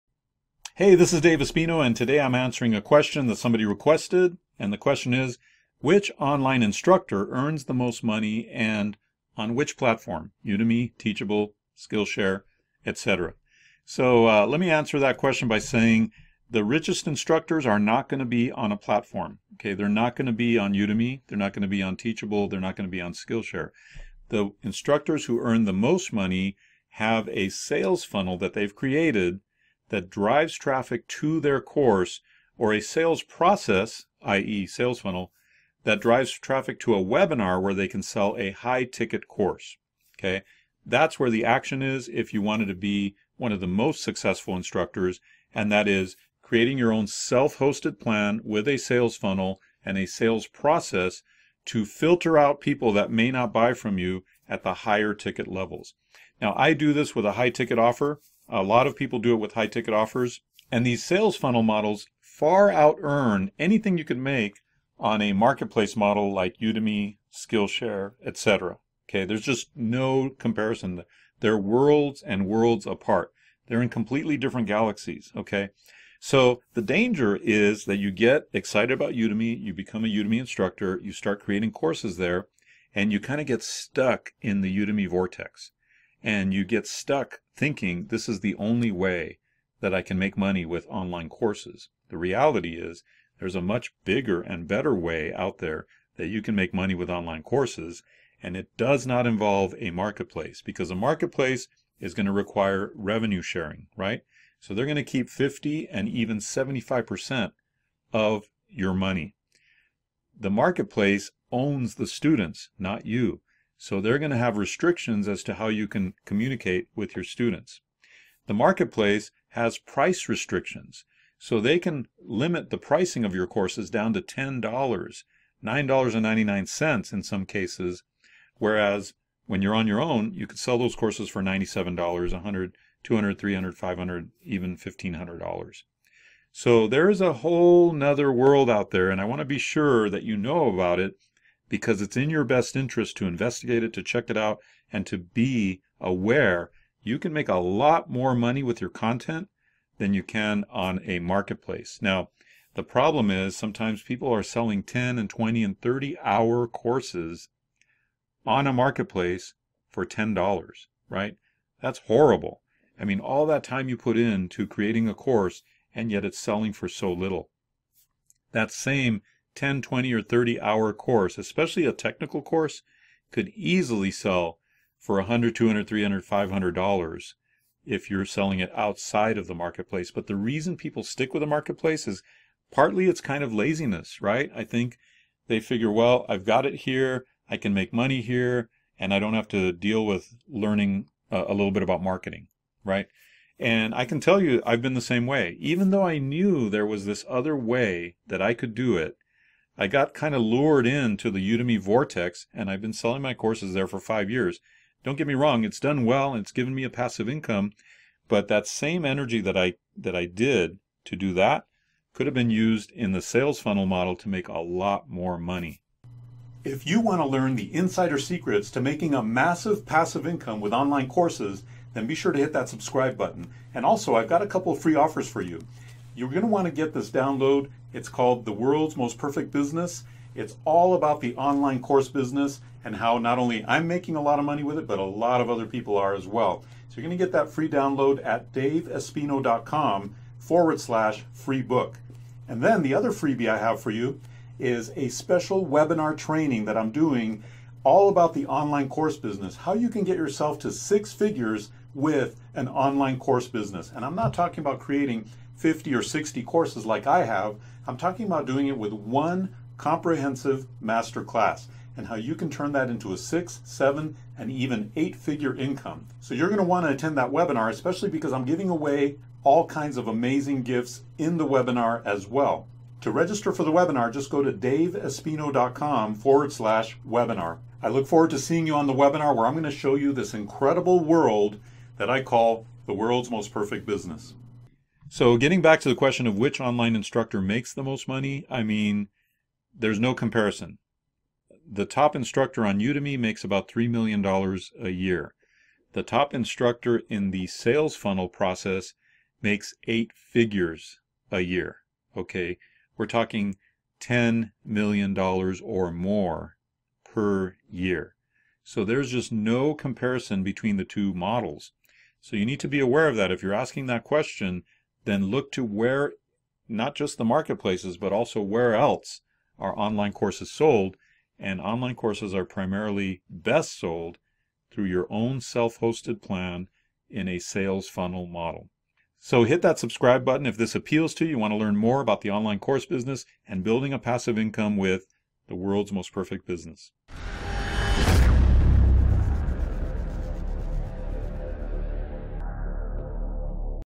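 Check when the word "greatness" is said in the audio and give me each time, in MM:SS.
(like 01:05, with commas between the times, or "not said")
not said.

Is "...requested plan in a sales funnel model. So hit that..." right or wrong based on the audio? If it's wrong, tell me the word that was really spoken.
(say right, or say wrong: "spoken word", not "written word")
wrong: "hosted", not "requested".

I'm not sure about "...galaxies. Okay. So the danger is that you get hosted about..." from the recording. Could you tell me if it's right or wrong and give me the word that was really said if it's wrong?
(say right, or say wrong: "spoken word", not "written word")
wrong: "excited", not "hosted".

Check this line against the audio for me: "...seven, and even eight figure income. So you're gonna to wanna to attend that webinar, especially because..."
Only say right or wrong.
right.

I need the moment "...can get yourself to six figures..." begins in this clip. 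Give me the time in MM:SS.
04:09.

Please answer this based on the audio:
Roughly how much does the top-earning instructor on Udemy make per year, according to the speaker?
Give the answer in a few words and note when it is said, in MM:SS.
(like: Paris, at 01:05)
$3 million, at 04:53.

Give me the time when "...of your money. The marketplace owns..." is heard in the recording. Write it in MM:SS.
01:48.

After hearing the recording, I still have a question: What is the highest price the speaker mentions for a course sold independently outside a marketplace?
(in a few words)
$1,500.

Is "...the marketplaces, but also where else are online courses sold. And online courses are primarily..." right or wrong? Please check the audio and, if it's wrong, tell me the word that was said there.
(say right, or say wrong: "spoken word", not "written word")
right.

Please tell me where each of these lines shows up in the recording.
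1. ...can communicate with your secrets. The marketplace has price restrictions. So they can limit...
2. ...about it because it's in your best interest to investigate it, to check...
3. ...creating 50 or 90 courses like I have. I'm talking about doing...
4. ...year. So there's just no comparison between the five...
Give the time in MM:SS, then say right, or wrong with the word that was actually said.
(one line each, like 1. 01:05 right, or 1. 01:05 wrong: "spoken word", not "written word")
1. 01:55 wrong: "students", not "secrets"
2. 02:20 right
3. 04:14 wrong: "60", not "90"
4. 05:07 wrong: "two", not "five".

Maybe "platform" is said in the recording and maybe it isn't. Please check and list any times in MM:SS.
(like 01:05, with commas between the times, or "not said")
00:09, 00:18.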